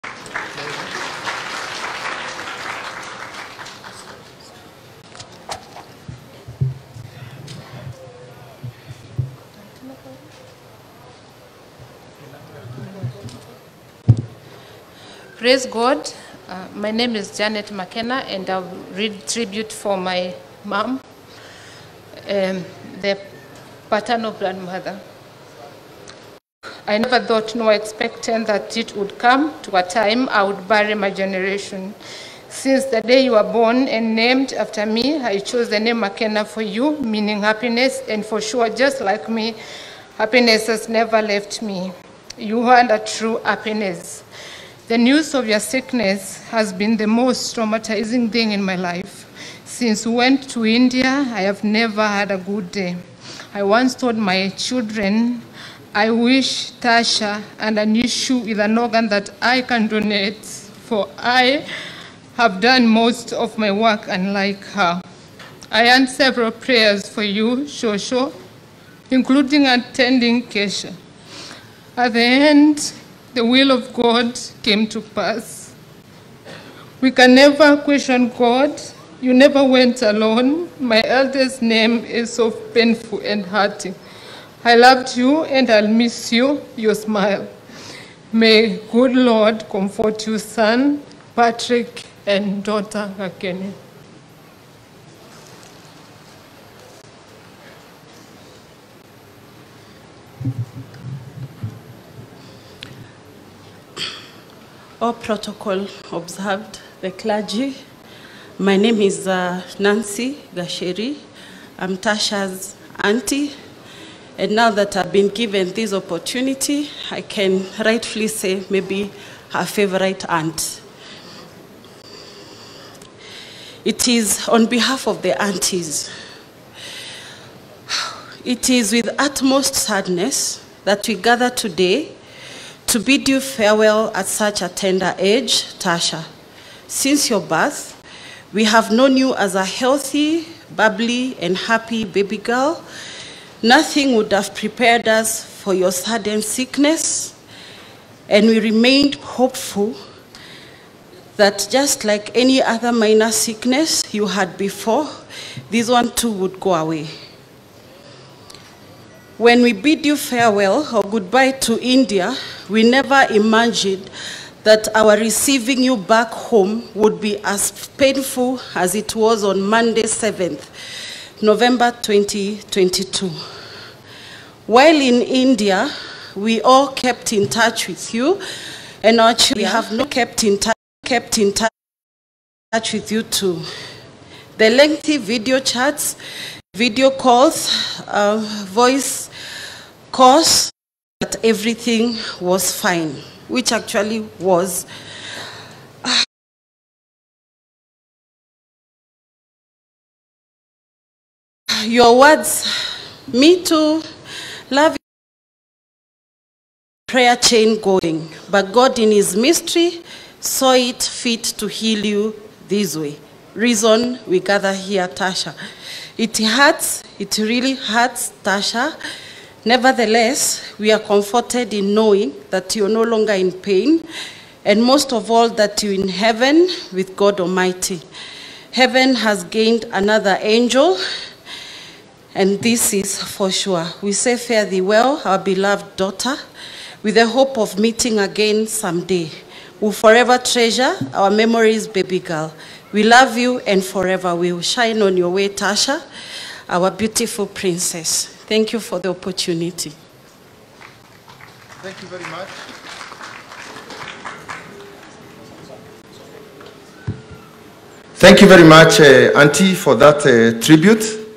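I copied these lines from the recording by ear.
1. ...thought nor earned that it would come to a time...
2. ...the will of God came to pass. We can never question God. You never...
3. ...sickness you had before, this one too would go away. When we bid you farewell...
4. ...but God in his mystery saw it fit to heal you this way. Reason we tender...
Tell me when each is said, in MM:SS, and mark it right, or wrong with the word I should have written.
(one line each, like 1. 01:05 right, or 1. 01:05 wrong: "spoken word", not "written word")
1. 00:27 wrong: "expected", not "earned"
2. 01:13 right
3. 02:33 right
4. 03:28 wrong: "gather", not "tender".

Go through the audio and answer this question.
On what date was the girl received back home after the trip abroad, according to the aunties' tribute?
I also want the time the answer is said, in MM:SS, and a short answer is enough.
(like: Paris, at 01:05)
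7 November 2022, at 02:50.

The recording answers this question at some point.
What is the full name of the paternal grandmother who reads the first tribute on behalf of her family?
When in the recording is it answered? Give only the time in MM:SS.
00:17.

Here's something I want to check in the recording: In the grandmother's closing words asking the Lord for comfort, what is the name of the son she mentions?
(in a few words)
Patrick.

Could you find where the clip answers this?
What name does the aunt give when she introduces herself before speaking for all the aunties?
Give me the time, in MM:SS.
01:49.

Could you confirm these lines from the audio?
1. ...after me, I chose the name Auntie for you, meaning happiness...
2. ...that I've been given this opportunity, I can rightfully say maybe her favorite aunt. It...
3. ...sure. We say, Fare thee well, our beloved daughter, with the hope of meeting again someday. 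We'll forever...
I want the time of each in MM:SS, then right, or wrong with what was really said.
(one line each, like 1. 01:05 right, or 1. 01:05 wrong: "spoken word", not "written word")
1. 00:34 wrong: "Makena", not "Auntie"
2. 01:54 right
3. 03:53 right.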